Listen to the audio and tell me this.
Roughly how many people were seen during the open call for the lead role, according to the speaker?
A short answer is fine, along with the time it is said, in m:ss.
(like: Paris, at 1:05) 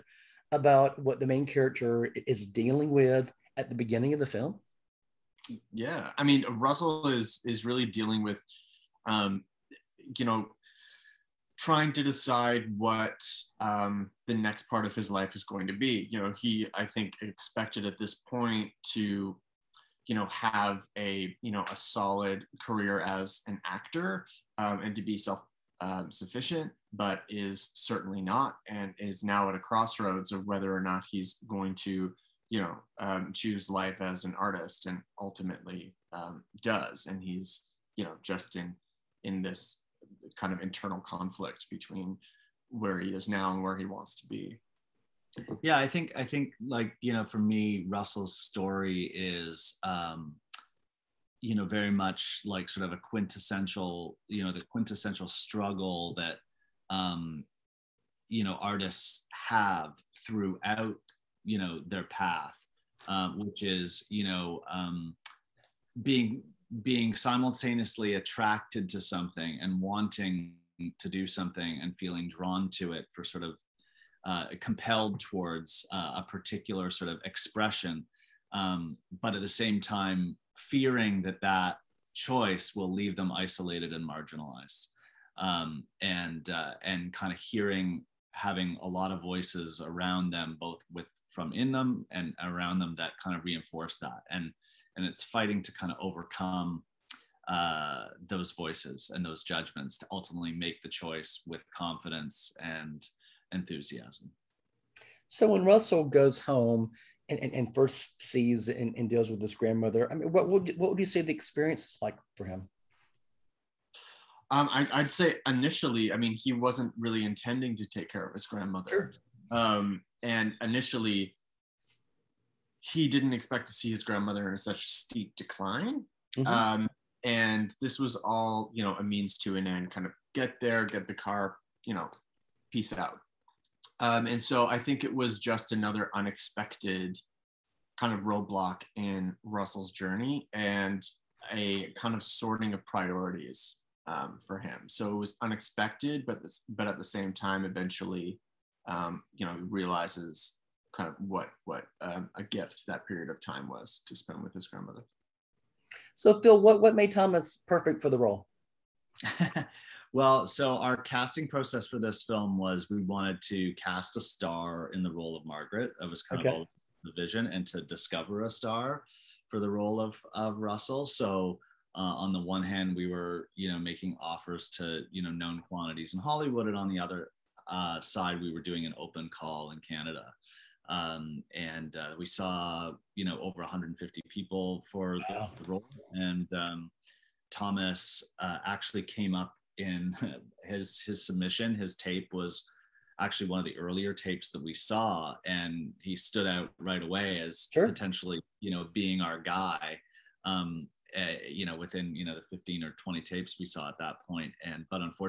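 over 150, at 3:03.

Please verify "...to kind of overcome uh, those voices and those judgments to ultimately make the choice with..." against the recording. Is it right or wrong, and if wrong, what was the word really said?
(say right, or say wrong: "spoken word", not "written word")
right.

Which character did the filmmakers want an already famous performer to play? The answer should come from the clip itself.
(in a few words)
Margaret.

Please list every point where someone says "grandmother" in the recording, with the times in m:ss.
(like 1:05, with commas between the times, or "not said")
1:49, 1:58, 2:04, 2:34.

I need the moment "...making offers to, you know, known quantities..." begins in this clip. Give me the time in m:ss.
2:53.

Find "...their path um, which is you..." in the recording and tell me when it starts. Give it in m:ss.
1:01.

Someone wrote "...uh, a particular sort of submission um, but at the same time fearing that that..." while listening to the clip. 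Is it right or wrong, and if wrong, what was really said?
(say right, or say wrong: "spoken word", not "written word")
wrong: "expression", not "submission".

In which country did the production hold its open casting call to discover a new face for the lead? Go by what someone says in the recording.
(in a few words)
Canada.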